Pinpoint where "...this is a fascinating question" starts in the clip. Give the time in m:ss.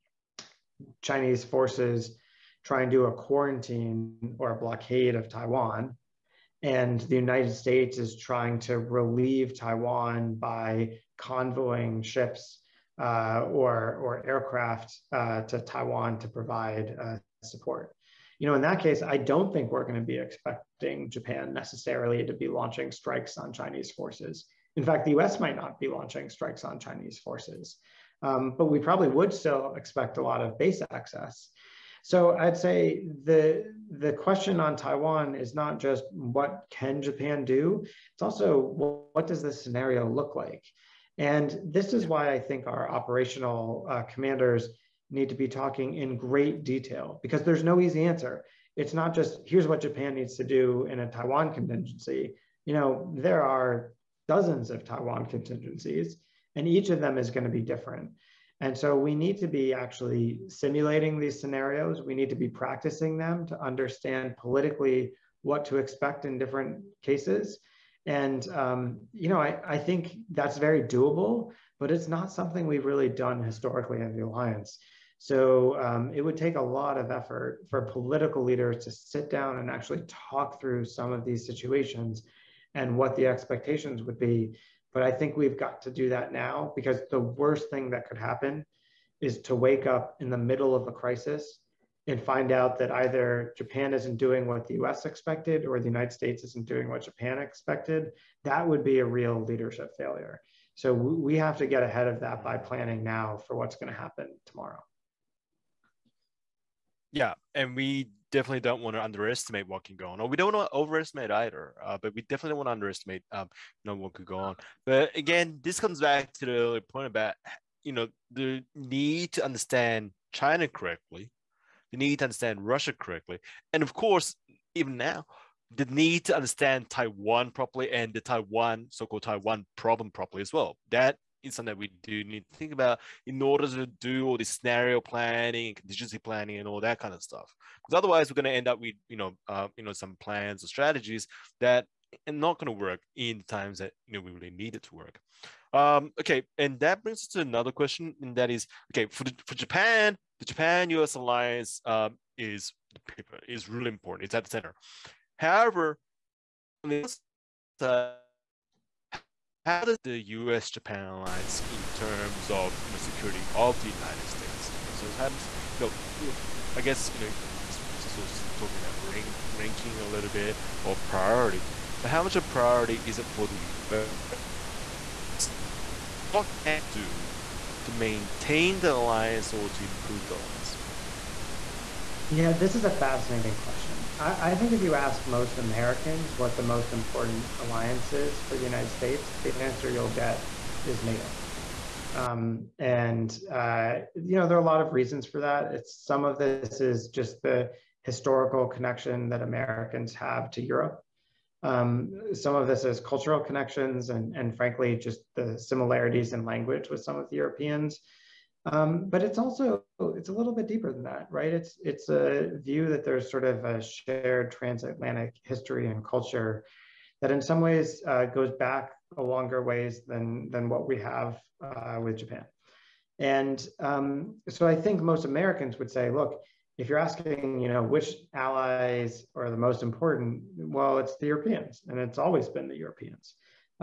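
3:02.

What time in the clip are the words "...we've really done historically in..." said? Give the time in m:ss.
1:12.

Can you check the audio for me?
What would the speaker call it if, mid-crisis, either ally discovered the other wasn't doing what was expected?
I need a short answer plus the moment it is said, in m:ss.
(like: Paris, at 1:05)
leadership failure, at 1:39.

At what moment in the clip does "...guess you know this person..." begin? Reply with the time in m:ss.
2:46.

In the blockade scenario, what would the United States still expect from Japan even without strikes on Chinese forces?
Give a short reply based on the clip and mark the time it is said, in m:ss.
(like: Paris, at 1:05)
base access, at 0:30.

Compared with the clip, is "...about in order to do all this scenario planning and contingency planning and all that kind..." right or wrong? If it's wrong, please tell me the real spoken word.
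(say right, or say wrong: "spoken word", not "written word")
right.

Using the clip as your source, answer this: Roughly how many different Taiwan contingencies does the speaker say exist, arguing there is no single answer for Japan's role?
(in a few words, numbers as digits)
dozens.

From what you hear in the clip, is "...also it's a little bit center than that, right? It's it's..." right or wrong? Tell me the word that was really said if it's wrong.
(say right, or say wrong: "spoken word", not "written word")
wrong: "deeper", not "center".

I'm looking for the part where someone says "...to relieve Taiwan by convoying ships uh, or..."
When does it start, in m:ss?
0:08.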